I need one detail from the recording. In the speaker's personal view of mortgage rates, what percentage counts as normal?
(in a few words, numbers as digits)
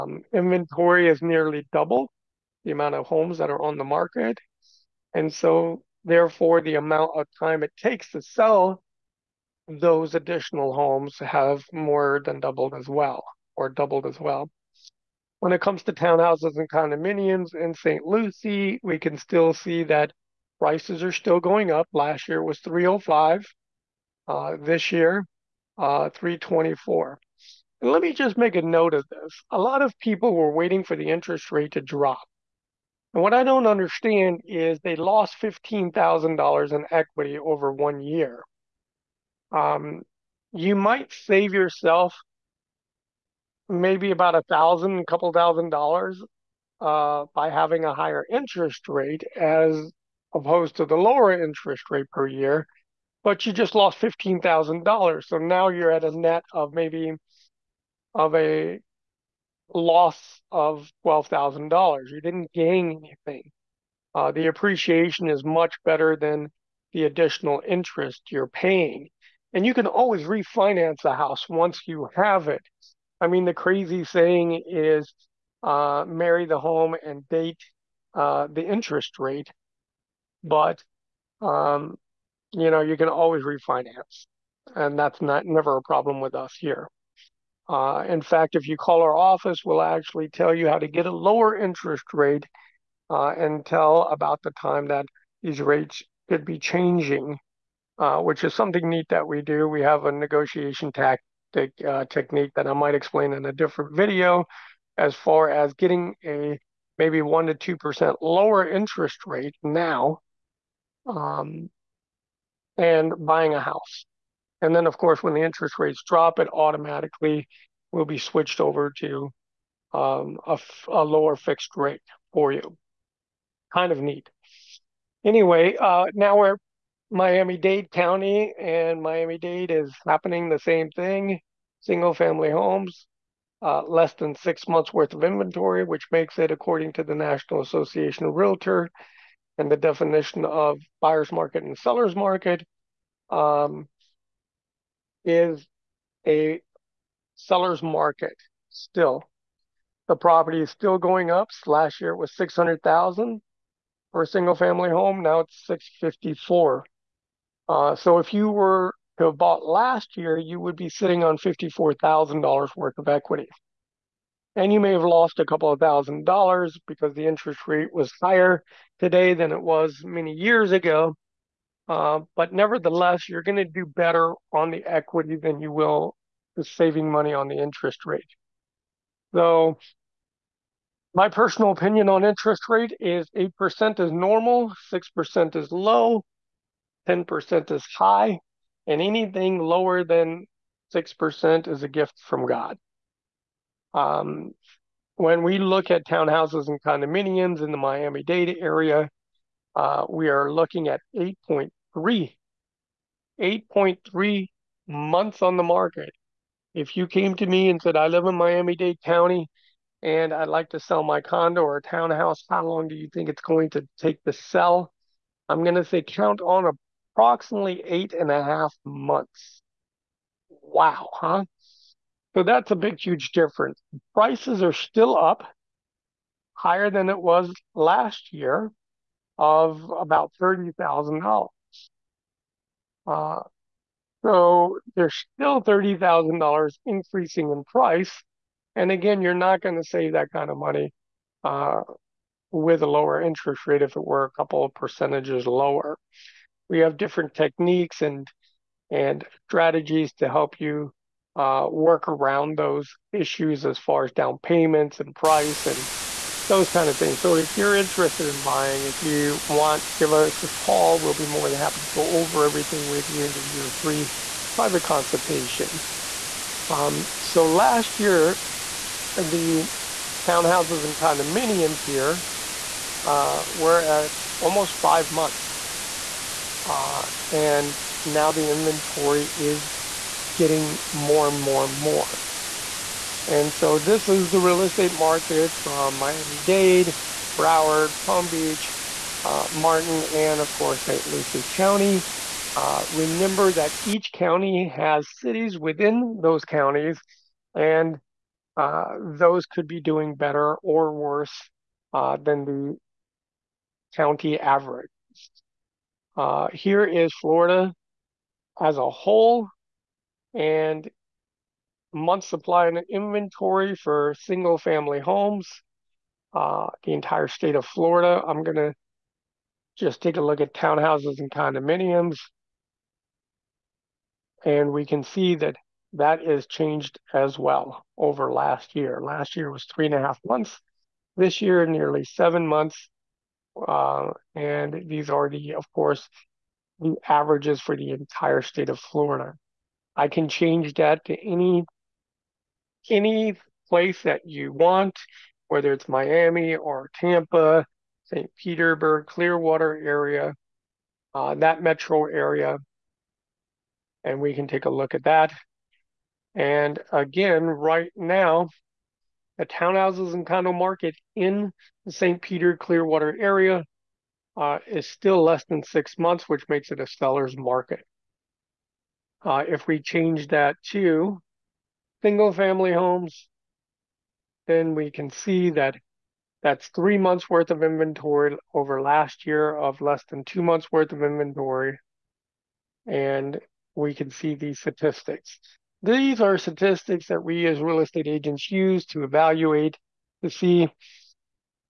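8%.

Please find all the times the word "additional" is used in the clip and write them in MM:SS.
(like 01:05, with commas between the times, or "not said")
00:10, 01:07.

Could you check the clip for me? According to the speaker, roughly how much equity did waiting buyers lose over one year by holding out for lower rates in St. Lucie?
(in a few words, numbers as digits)
$15,000.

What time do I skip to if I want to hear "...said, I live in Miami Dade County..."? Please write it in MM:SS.
03:27.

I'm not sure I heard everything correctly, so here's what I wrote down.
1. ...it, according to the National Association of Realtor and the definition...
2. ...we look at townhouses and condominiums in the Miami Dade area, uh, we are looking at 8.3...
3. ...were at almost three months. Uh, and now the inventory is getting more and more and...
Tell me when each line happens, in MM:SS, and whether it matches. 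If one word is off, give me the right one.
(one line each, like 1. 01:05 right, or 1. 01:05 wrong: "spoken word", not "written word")
1. 02:16 right
2. 03:15 right
3. 04:33 wrong: "five", not "three".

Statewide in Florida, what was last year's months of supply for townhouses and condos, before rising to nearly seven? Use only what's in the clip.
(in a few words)
3.5 months.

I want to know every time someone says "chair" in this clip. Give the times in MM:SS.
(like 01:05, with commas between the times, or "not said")
not said.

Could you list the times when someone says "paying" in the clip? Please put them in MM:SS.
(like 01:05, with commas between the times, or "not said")
01:08.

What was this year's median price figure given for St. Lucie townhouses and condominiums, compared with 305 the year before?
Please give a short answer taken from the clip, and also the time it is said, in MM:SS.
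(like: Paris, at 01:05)
324, at 00:26.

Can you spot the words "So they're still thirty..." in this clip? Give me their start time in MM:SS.
03:54.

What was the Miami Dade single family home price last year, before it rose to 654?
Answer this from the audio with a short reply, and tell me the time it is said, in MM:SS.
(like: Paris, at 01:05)
600,000, at 02:32.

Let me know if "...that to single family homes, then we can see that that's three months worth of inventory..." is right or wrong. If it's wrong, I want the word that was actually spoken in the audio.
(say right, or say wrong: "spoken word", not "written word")
right.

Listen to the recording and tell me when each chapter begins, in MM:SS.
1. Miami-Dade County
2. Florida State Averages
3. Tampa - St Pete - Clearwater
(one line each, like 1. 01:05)
1. 02:06
2. 05:05
3. 05:47.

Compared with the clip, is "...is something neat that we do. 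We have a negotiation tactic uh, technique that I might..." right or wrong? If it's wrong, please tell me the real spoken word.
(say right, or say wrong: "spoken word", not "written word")
right.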